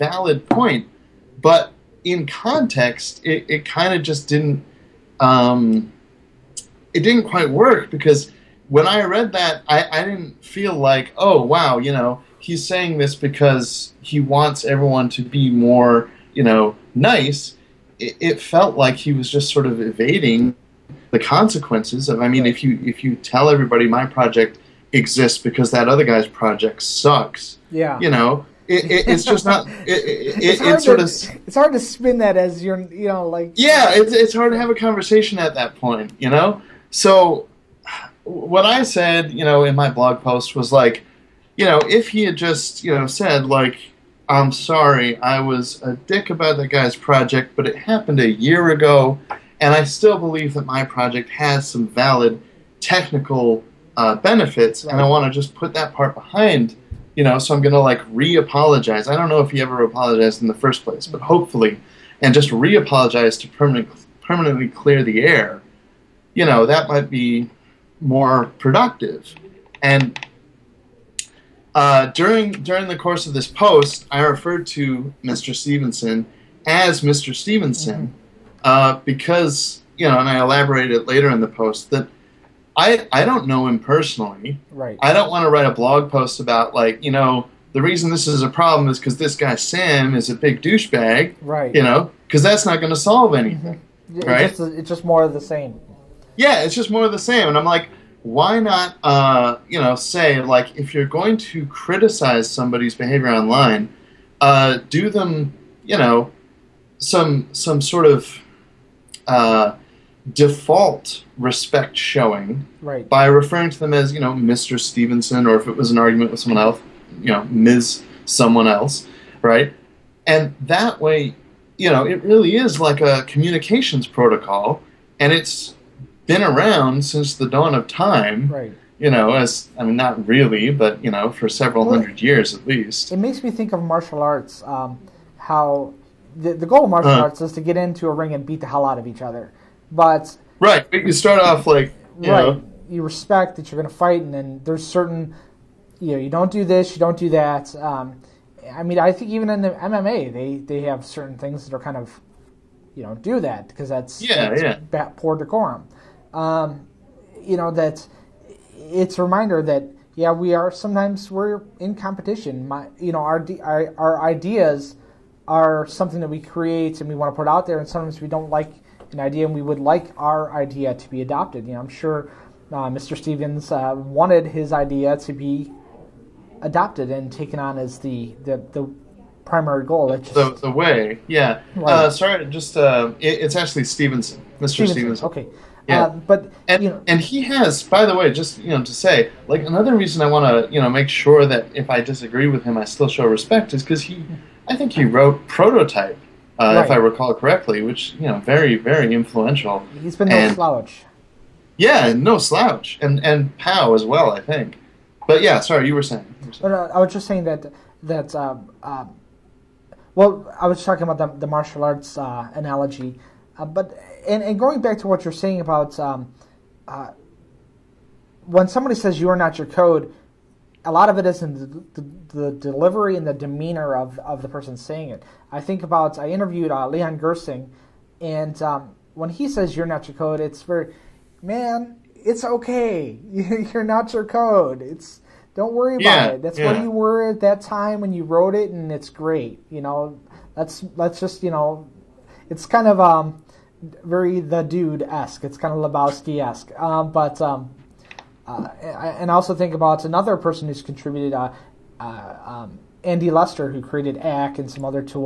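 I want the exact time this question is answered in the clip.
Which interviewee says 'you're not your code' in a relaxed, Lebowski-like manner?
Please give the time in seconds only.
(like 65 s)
226 s.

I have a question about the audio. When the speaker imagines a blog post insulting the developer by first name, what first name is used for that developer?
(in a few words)
Sam.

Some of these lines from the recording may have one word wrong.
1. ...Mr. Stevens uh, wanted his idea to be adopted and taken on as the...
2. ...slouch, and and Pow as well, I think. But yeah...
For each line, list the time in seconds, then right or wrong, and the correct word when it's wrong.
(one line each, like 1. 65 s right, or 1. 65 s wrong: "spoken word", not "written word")
1. 172 s right
2. 202 s right.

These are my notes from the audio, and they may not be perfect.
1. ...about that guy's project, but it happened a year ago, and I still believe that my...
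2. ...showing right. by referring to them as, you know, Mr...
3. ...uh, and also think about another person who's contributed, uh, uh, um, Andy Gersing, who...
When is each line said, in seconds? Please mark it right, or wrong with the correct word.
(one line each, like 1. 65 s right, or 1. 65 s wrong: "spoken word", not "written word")
1. 46 s right
2. 111 s right
3. 248 s wrong: "Lester", not "Gersing".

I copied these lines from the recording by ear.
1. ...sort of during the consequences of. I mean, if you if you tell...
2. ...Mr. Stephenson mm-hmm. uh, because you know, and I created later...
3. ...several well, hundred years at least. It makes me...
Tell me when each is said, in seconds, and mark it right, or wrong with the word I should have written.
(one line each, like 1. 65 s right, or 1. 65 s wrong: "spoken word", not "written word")
1. 19 s wrong: "evading", not "during"
2. 77 s wrong: "elaborated", not "created"
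3. 131 s right.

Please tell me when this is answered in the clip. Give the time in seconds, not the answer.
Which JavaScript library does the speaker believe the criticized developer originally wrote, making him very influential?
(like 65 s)
195 s.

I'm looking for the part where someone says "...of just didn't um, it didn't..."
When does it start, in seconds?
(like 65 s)
3 s.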